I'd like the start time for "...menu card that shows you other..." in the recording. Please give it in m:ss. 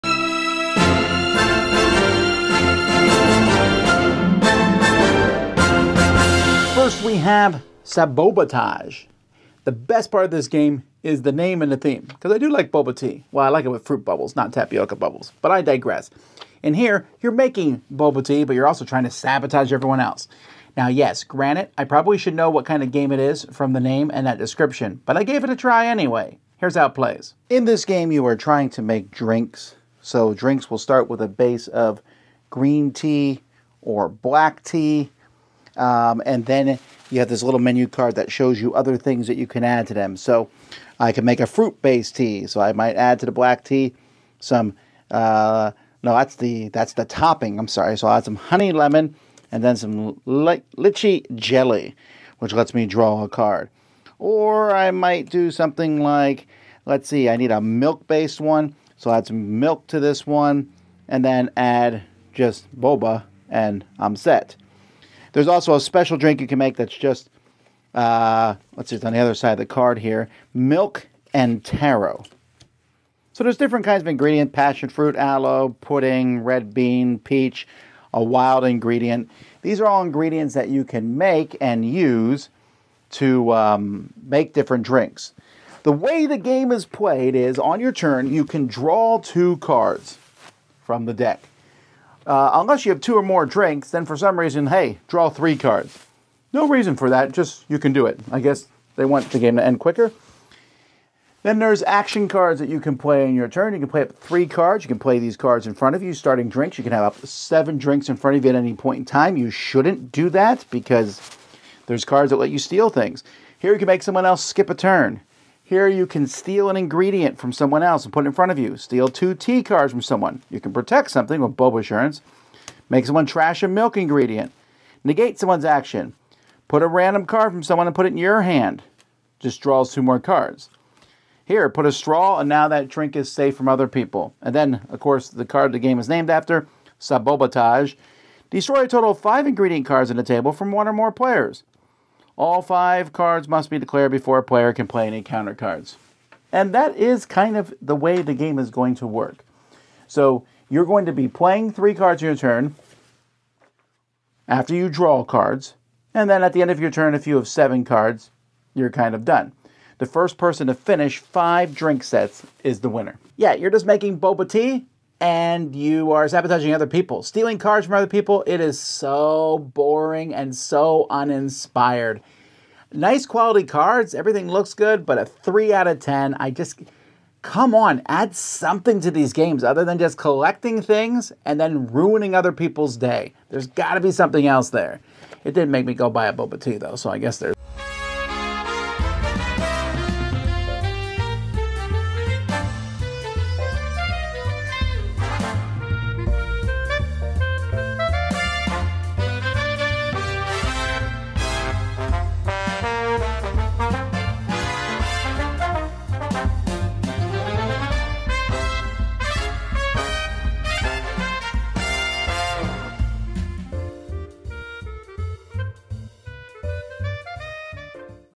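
0:37.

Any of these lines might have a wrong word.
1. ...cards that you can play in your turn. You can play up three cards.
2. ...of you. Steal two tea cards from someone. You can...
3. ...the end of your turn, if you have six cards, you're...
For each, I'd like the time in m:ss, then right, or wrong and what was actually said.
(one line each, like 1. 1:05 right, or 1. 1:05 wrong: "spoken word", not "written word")
1. 1:42 right
2. 1:58 right
3. 2:36 wrong: "seven", not "six".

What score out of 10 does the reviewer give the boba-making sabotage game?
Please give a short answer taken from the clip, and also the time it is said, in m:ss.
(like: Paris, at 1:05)
3, at 2:55.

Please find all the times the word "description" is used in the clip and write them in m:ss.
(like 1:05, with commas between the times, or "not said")
0:24.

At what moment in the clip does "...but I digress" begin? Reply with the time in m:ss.
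0:15.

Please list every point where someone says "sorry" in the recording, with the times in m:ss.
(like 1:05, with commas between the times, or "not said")
0:47.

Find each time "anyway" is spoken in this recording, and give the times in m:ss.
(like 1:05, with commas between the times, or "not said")
0:25.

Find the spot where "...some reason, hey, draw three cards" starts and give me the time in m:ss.
1:34.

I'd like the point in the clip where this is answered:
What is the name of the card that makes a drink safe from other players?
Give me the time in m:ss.
2:11.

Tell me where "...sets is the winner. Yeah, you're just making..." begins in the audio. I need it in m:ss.
2:42.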